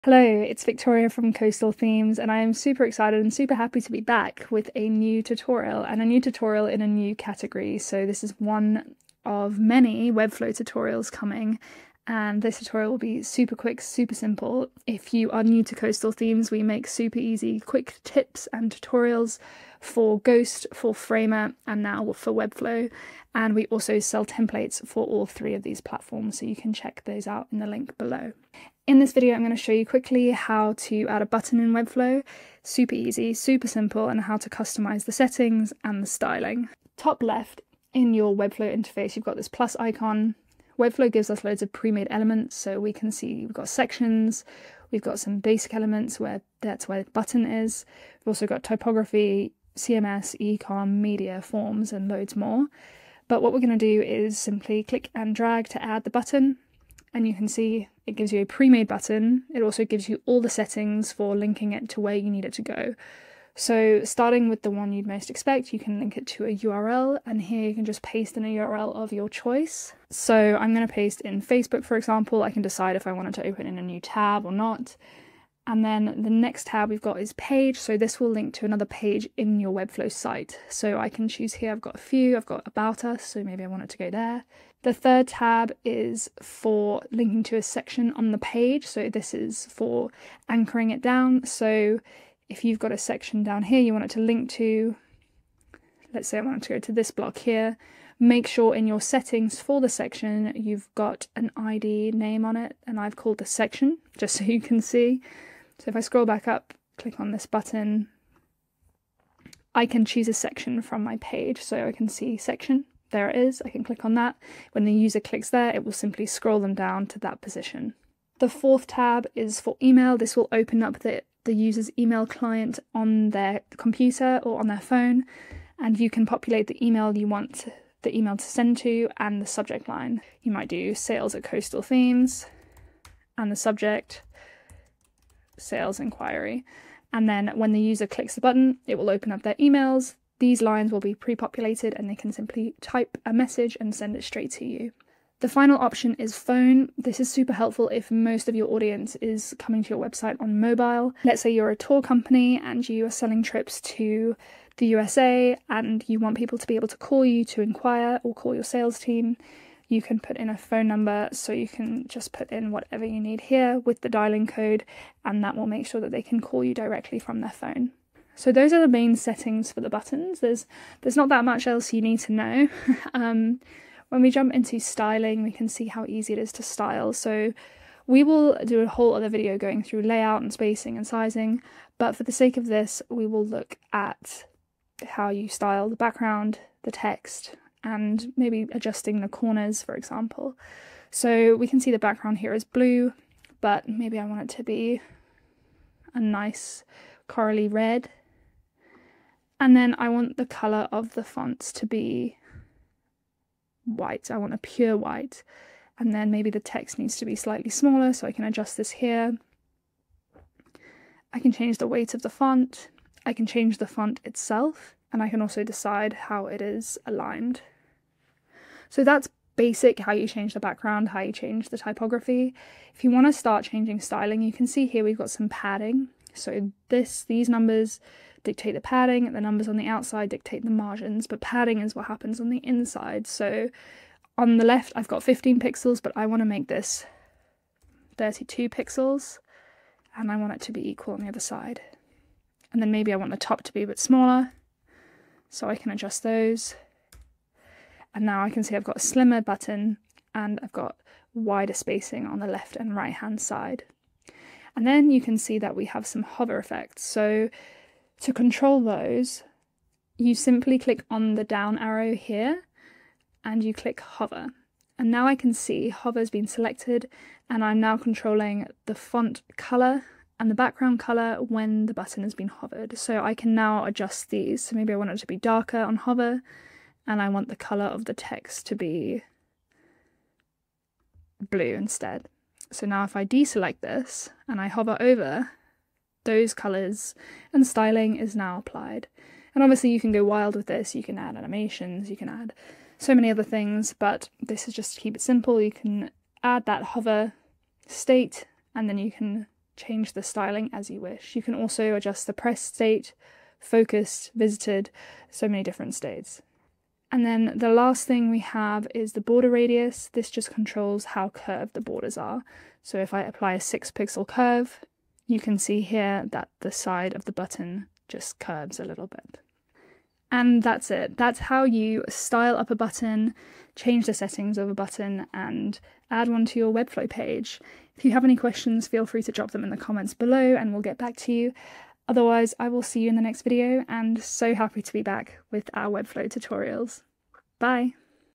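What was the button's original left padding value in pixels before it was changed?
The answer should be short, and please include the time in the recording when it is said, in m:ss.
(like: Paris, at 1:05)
15, at 3:55.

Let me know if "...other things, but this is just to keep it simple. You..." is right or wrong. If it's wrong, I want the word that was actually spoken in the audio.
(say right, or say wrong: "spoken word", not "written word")
right.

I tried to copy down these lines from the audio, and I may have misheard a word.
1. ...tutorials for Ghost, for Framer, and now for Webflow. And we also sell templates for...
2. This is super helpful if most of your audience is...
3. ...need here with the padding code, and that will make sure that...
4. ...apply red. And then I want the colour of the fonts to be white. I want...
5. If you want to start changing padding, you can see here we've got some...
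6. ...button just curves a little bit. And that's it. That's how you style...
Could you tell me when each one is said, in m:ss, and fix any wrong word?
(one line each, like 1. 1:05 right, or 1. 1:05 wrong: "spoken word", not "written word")
1. 0:18 right
2. 2:26 right
3. 2:43 wrong: "dialing", not "padding"
4. 3:17 wrong: "corally", not "apply"
5. 3:42 wrong: "styling", not "padding"
6. 5:17 right.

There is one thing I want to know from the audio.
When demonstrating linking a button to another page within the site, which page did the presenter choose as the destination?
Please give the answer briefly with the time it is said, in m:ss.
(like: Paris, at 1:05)
About us, at 1:22.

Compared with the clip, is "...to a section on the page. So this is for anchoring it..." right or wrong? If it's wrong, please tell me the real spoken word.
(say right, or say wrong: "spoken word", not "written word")
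right.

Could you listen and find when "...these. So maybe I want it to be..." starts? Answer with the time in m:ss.
4:34.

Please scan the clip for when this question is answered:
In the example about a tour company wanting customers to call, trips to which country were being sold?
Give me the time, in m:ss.
2:34.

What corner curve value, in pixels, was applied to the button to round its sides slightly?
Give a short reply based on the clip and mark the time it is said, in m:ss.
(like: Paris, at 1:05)
6, at 5:13.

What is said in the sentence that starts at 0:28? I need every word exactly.
In this video, I'm going to show you quickly how to add a button in Webflow.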